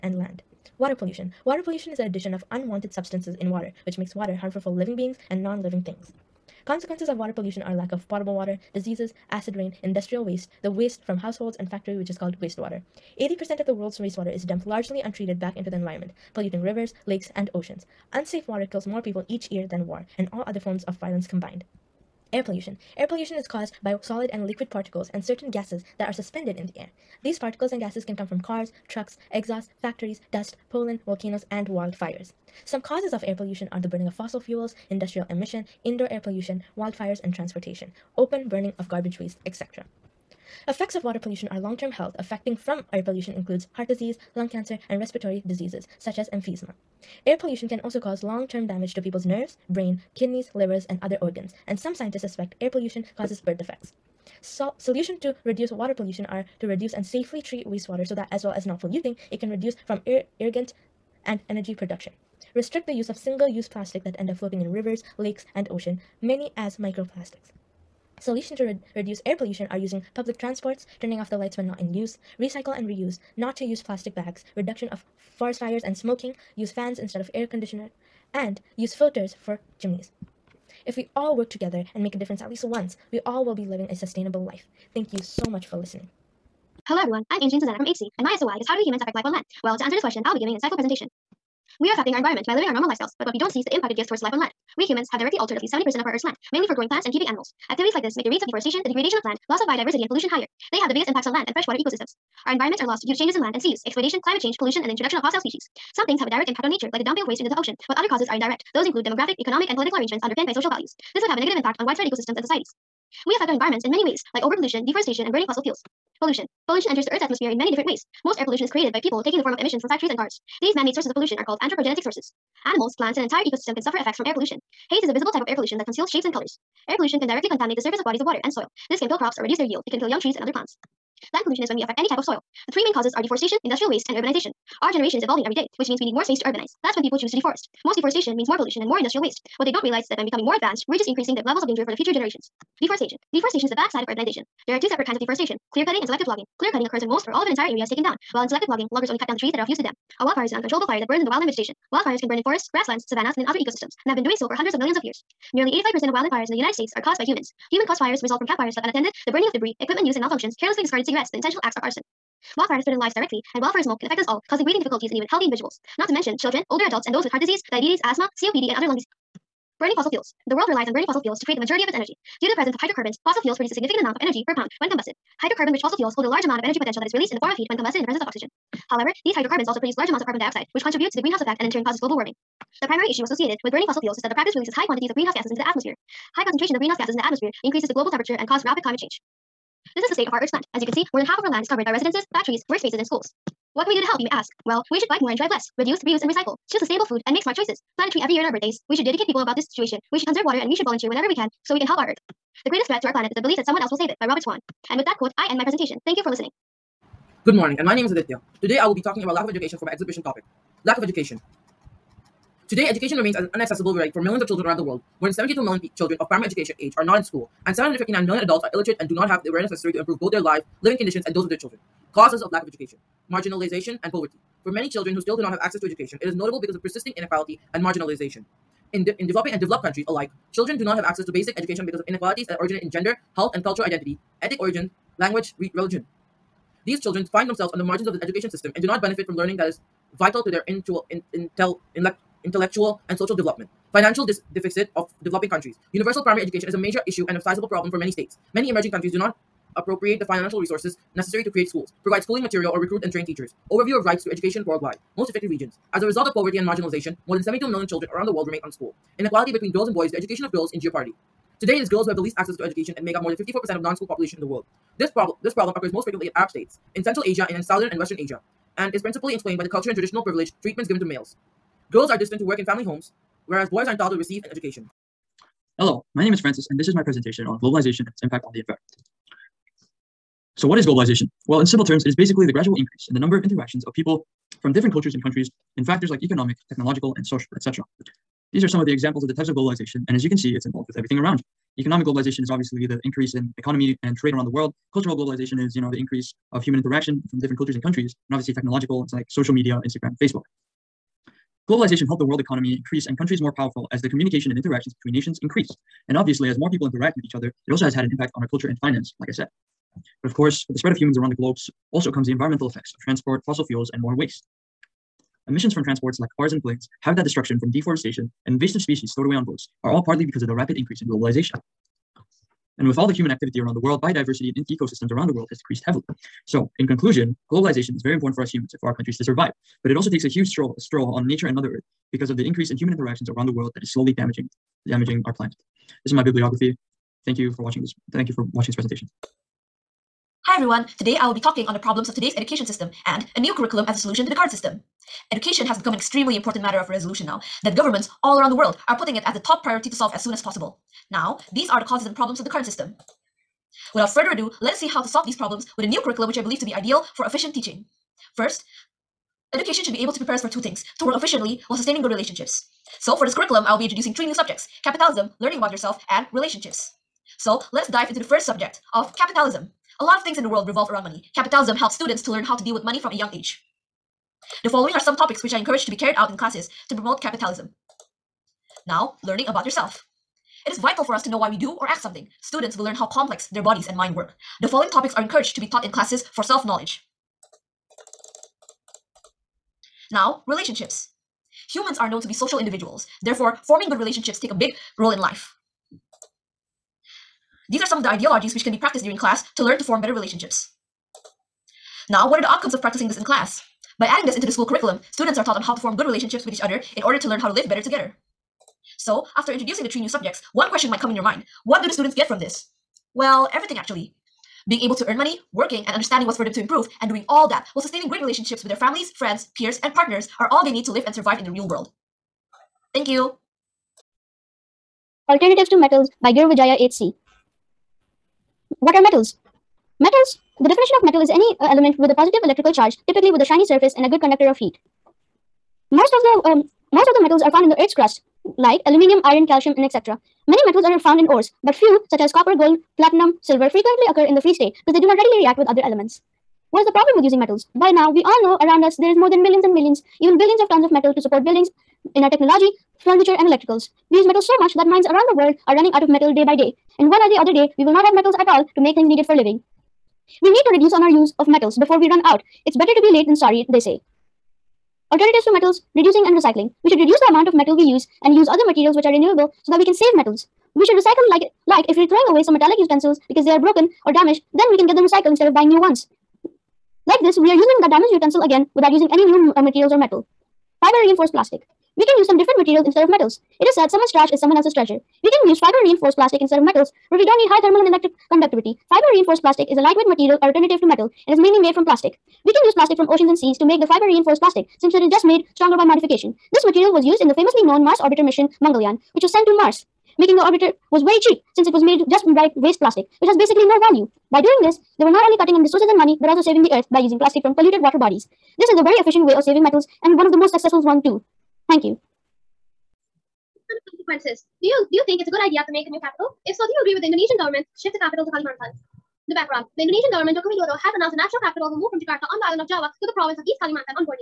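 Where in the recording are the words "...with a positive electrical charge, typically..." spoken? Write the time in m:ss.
7:11.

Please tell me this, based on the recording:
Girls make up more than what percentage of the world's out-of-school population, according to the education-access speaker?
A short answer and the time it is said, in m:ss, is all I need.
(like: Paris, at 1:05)
54%, at 4:23.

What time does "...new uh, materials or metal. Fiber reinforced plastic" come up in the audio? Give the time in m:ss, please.
7:59.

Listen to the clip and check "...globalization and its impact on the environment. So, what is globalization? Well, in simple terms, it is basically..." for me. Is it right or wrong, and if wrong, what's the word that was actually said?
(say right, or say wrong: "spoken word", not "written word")
right.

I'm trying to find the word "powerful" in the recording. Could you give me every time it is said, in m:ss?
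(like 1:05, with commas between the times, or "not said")
5:03.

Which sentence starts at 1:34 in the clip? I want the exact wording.
We humans have directly altered at least 70% of our Earth's land, mainly for growing plants and keeping animals.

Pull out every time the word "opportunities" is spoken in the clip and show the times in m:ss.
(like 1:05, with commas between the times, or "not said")
not said.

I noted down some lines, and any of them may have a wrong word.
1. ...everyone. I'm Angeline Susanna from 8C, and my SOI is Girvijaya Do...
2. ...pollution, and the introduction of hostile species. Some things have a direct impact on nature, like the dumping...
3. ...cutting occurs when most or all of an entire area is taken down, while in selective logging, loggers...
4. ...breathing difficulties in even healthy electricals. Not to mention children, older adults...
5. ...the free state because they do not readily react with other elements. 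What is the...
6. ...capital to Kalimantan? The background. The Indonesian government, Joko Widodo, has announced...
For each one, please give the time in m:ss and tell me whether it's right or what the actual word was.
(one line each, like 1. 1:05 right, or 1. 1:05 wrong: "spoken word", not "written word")
1. 1:26 wrong: "How", not "Girvijaya"
2. 1:44 right
3. 2:26 right
4. 2:44 wrong: "individuals", not "electricals"
5. 7:24 right
6. 8:38 right.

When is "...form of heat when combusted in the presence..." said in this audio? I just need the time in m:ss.
2:57.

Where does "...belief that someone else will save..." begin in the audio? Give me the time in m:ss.
3:23.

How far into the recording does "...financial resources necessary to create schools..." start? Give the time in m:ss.
4:10.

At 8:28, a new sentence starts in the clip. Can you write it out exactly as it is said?
This is a very efficient way of saving metals and one of the most successful ones too.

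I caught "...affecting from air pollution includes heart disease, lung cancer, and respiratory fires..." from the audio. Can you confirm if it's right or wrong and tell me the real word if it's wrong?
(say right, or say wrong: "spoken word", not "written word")
wrong: "diseases", not "fires".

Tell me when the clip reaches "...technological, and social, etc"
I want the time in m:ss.
4:46.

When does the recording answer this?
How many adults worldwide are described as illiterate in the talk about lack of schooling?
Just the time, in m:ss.
3:37.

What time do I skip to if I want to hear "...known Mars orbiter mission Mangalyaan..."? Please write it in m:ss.
8:17.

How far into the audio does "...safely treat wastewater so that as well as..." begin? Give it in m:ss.
0:57.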